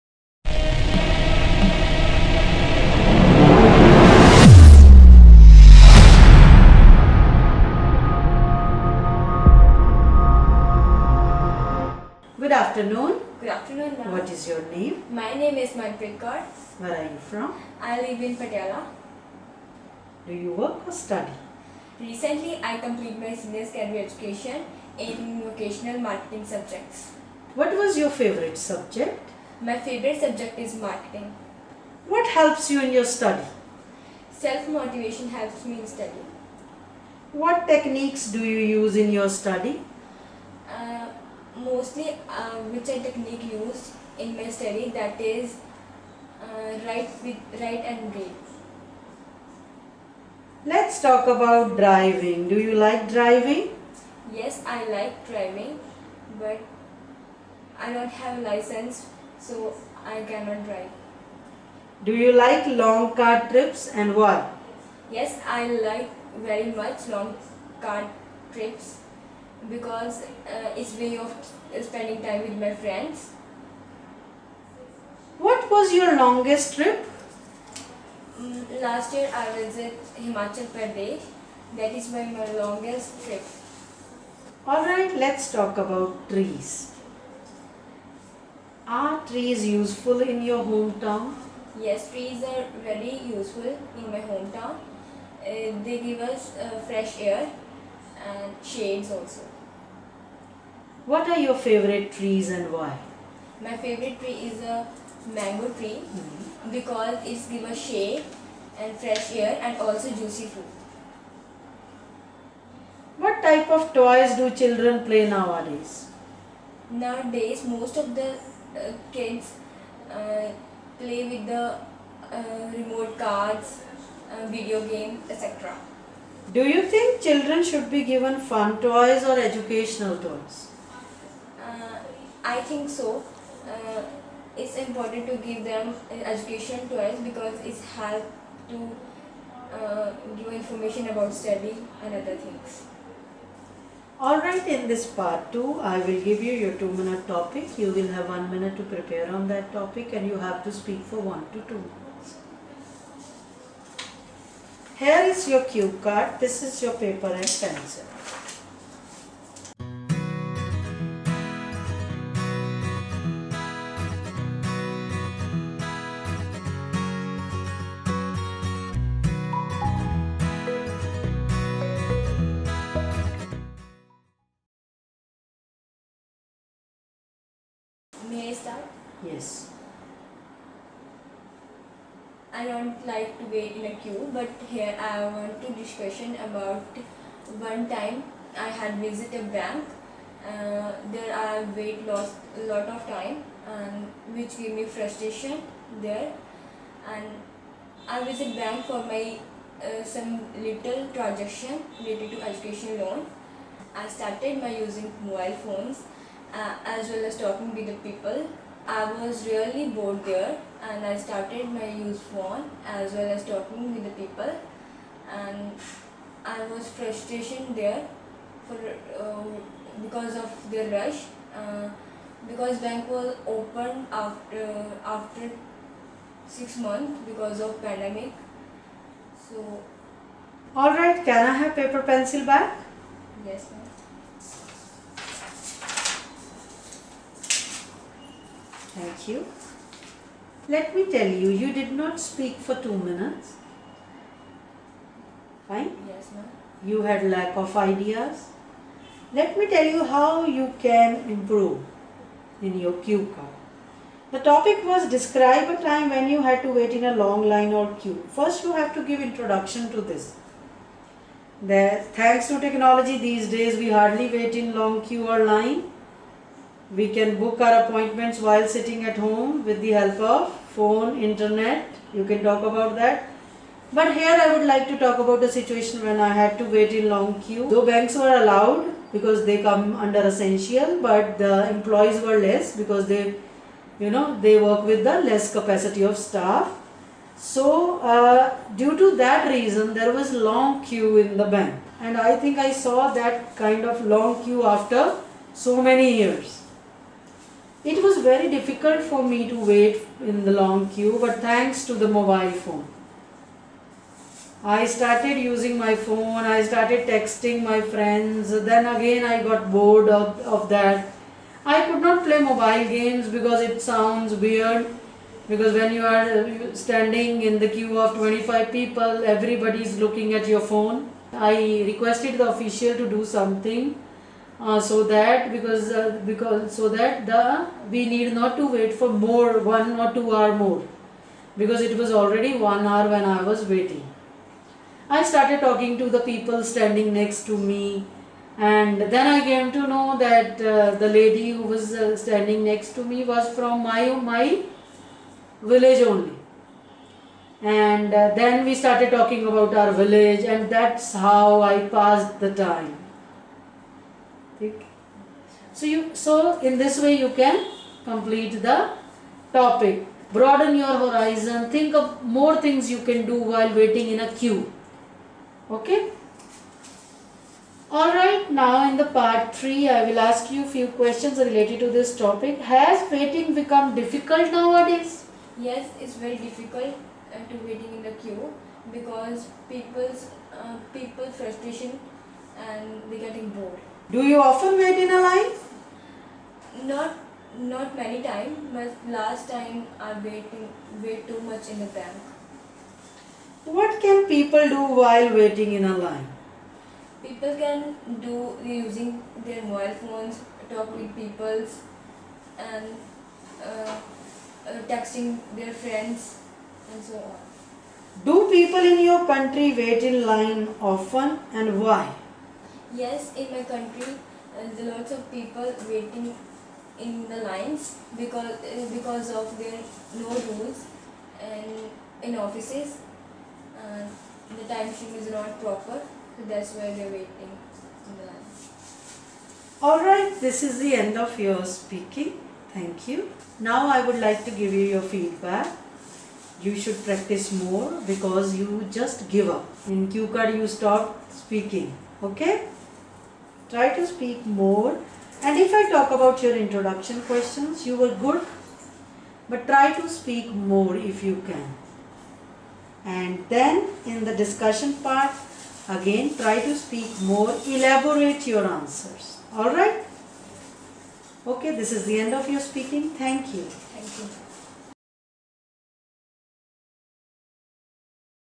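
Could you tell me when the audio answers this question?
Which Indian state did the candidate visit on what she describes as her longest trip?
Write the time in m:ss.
1:20.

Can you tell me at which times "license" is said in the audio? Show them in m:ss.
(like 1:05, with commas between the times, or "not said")
0:58.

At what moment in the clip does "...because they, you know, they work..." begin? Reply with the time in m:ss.
4:42.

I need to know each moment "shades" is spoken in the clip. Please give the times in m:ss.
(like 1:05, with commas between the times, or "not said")
1:38, 1:47.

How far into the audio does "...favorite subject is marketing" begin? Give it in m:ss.
0:29.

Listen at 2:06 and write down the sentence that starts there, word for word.
Do you think children should be given fun toys or educational toys?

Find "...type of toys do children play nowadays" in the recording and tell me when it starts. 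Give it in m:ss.
1:53.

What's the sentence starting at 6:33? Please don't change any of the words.
What can people do while waiting in a line?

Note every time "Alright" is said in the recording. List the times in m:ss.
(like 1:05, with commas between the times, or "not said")
1:24, 2:24, 6:07, 7:09, 7:39.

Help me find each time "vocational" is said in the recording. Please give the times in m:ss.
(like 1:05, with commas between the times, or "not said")
0:25.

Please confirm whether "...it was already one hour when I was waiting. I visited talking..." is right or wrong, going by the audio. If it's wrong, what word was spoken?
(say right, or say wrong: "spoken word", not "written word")
wrong: "started", not "visited".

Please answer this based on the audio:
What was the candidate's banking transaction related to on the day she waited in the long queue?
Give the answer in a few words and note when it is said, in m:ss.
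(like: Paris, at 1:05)
education loan, at 3:22.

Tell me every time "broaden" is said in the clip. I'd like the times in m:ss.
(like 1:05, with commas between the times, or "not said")
6:00.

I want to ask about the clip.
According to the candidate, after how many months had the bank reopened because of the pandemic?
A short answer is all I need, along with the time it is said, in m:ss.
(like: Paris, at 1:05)
6, at 3:46.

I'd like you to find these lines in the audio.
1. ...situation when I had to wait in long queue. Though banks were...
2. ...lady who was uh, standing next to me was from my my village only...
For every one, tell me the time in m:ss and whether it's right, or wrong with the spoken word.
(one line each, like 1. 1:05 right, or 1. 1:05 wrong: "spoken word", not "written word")
1. 4:35 right
2. 5:41 right.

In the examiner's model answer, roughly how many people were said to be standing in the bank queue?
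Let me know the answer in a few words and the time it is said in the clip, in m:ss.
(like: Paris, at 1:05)
25, at 5:18.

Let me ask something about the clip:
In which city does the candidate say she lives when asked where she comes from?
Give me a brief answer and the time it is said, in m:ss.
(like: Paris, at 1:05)
Patiala, at 0:18.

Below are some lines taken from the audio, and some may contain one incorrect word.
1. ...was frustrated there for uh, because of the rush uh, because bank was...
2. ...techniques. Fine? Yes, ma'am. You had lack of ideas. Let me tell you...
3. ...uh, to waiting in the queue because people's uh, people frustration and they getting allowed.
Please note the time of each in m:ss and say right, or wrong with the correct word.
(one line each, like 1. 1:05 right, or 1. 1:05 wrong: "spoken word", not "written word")
1. 3:36 right
2. 4:02 wrong: "minutes", not "techniques"
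3. 6:17 wrong: "bored", not "allowed".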